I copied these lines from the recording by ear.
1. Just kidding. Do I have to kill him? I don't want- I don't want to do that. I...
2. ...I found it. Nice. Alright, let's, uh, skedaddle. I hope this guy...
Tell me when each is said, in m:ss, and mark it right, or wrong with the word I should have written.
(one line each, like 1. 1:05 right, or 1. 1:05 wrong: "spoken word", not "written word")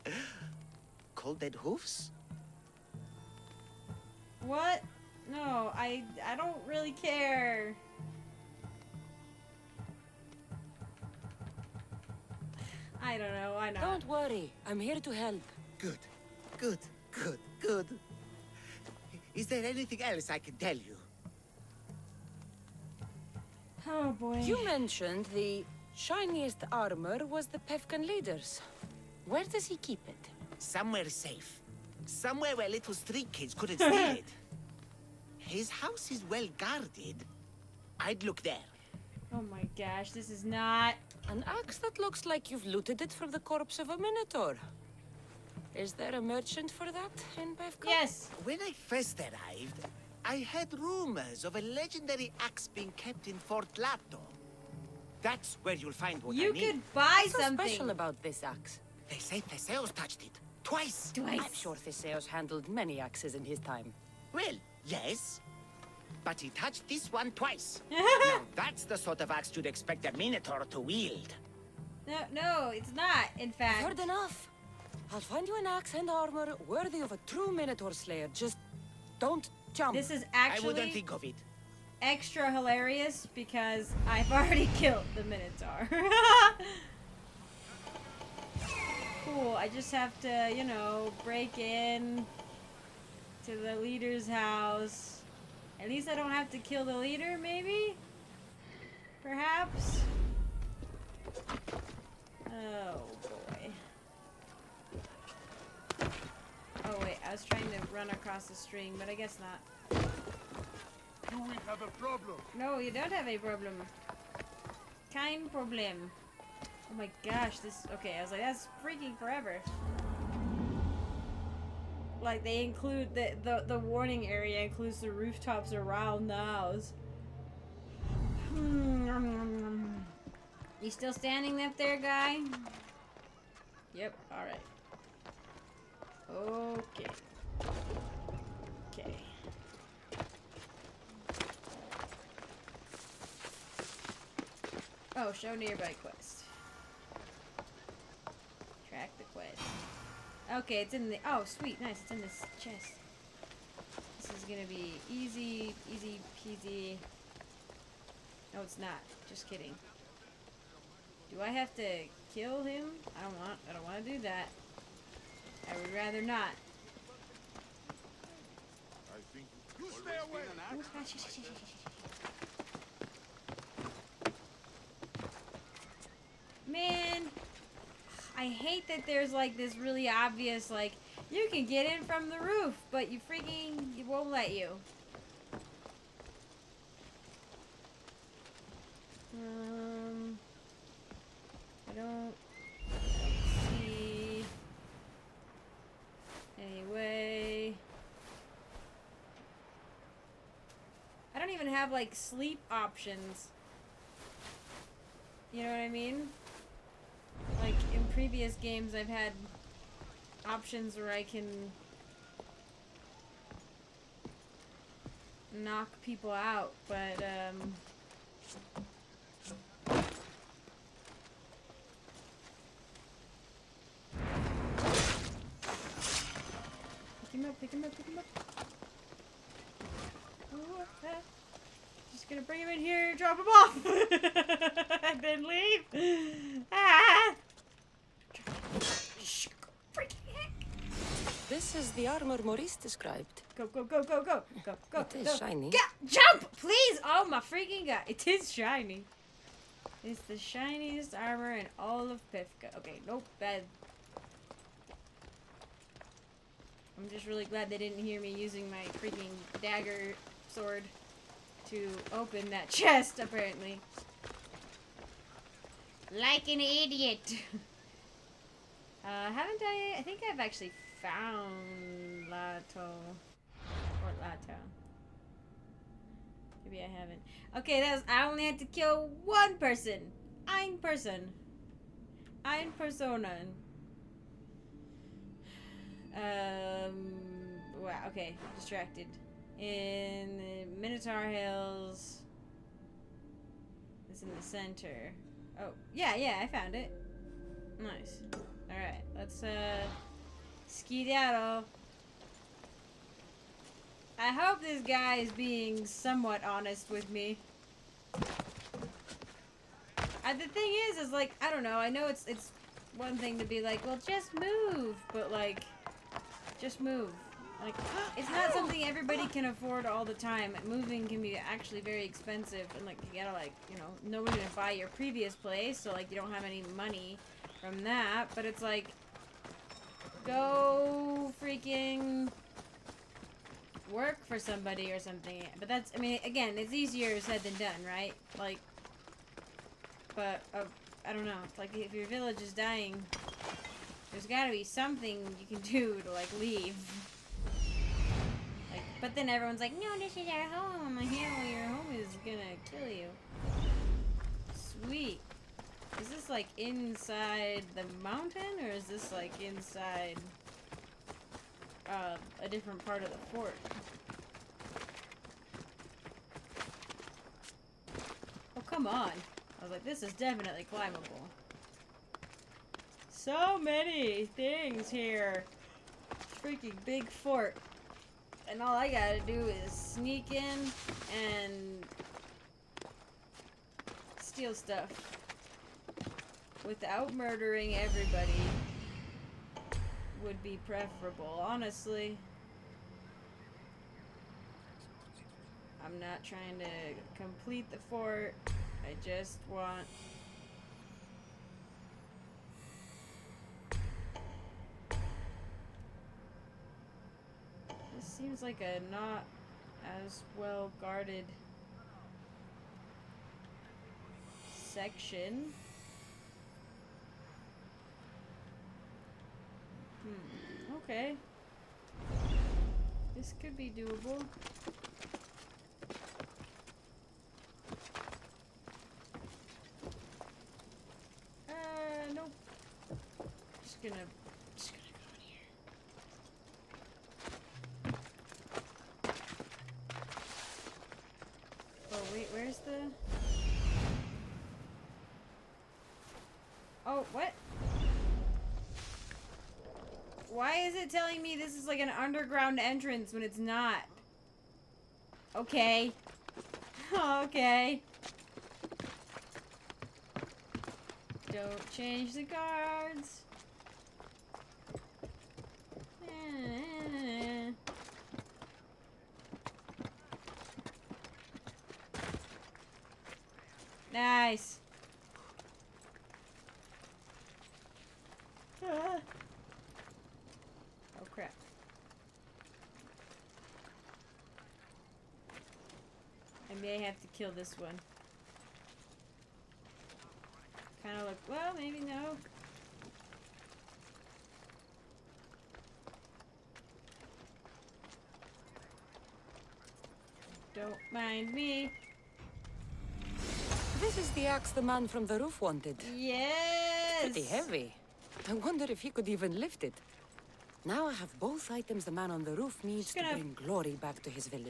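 1. 2:39 right
2. 4:56 right.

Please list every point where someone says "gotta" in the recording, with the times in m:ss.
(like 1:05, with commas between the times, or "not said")
5:23, 5:44, 6:18.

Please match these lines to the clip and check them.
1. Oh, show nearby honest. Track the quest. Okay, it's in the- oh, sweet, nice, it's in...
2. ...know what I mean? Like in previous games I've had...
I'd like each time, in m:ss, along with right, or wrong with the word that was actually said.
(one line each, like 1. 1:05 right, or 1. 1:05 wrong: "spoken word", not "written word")
1. 2:25 wrong: "quest", not "honest"
2. 3:25 right.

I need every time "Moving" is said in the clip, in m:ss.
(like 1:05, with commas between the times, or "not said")
5:20.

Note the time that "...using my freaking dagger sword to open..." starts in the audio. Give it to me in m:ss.
4:18.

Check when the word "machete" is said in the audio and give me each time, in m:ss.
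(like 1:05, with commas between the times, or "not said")
not said.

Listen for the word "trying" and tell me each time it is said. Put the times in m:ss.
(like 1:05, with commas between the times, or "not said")
1:47, 6:36.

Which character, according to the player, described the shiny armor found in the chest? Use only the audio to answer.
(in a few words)
Maurice.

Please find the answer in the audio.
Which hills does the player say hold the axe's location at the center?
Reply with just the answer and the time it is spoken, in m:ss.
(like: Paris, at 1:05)
Minotaur Hills, at 4:50.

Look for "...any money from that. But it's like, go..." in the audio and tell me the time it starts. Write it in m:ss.
5:26.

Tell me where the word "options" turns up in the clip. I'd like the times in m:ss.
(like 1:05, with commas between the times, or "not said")
3:22, 3:30.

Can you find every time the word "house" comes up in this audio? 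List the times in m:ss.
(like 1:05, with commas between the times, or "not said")
0:35, 1:34, 2:06.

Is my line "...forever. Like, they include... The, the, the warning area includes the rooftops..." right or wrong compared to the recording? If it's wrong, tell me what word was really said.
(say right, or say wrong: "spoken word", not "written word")
right.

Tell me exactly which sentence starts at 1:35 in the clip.
At least I don't have to kill the leader, maybe?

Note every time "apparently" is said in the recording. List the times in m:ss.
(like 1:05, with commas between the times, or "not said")
4:23.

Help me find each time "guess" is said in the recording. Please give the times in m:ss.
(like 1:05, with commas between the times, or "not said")
1:49.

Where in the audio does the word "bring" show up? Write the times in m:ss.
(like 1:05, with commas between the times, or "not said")
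3:52, 8:33.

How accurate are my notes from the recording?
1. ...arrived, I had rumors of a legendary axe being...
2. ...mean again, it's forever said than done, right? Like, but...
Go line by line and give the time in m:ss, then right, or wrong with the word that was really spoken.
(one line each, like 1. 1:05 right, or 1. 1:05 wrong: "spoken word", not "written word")
1. 0:49 right
2. 5:35 wrong: "easier", not "forever".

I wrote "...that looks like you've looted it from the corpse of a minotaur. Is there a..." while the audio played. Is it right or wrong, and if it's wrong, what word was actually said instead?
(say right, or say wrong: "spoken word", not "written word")
right.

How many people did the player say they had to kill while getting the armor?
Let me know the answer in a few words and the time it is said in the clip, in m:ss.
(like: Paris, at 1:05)
1, at 4:39.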